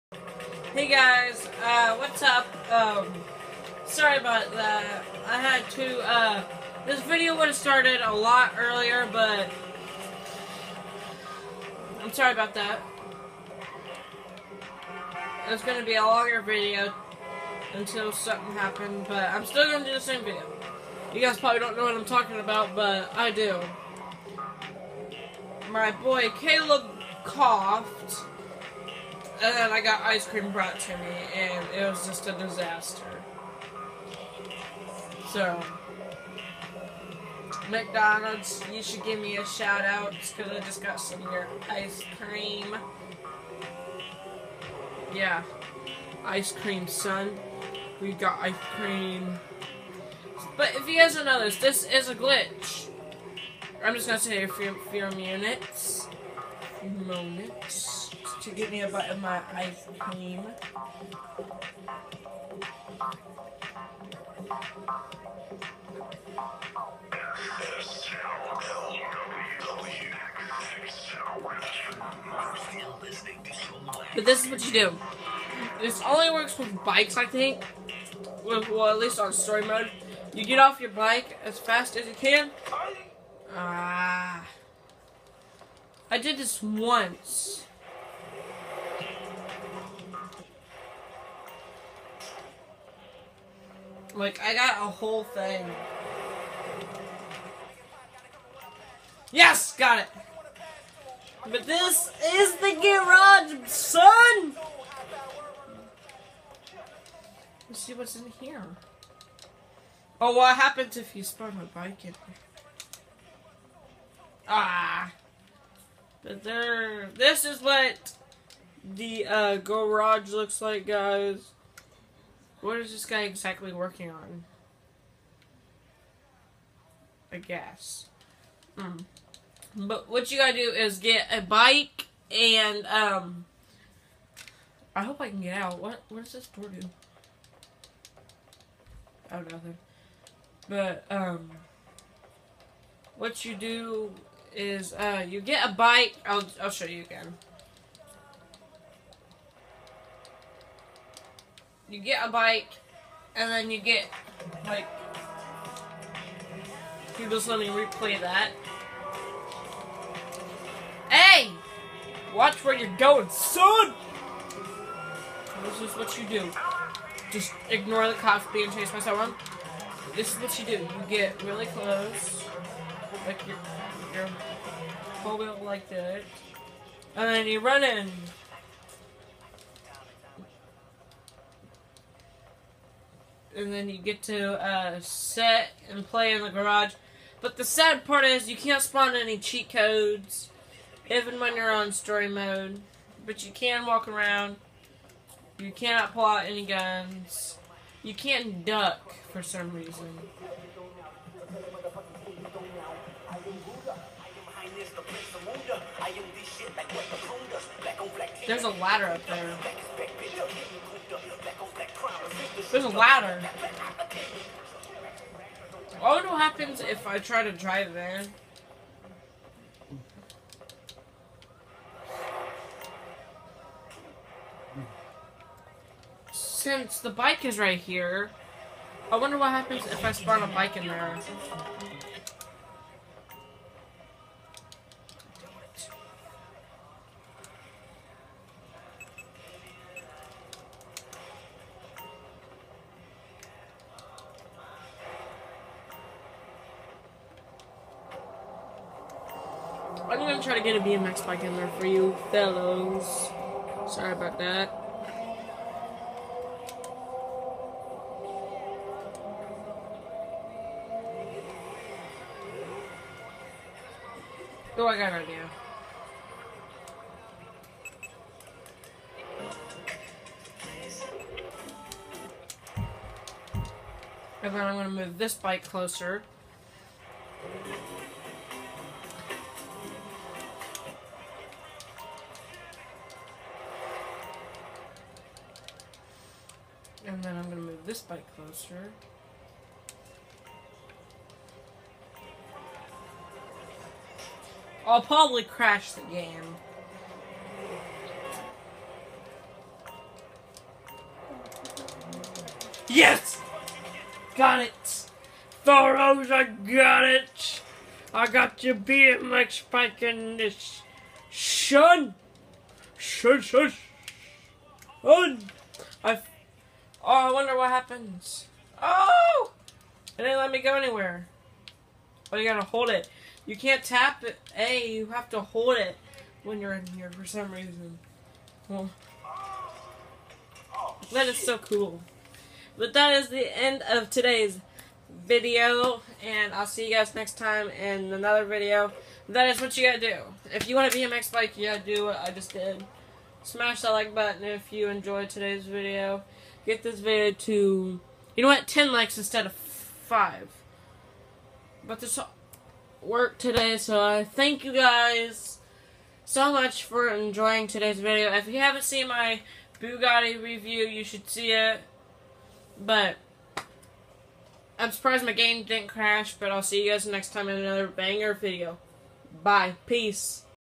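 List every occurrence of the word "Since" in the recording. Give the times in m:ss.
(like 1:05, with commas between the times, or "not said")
3:46.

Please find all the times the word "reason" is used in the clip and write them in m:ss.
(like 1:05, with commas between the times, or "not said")
3:19, 5:27.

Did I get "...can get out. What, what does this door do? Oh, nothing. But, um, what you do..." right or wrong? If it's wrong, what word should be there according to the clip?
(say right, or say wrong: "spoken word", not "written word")
right.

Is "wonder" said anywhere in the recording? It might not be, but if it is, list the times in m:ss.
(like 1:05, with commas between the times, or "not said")
3:36, 3:49, 5:17.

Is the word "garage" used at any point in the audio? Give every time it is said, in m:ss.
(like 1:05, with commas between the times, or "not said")
1:42, 1:59, 3:06.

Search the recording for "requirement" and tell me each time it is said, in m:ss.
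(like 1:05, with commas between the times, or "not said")
not said.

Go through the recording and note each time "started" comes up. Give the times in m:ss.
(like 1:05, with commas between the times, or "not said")
0:07.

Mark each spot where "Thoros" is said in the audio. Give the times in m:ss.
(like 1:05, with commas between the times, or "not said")
5:05.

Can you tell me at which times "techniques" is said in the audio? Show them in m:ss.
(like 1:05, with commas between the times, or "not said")
not said.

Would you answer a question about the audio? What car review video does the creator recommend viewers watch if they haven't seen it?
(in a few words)
Bugatti review.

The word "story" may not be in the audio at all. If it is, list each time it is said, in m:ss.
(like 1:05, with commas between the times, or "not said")
1:19, 3:11.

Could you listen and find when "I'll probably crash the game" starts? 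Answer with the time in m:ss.
4:54.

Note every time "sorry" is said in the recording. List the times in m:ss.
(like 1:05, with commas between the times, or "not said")
0:03, 0:12, 4:13.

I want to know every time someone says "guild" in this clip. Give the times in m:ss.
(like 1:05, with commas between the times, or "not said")
not said.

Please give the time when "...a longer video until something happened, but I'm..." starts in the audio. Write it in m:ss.
0:15.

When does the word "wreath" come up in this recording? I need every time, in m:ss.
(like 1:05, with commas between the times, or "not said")
not said.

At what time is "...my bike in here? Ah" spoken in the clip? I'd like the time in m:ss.
1:51.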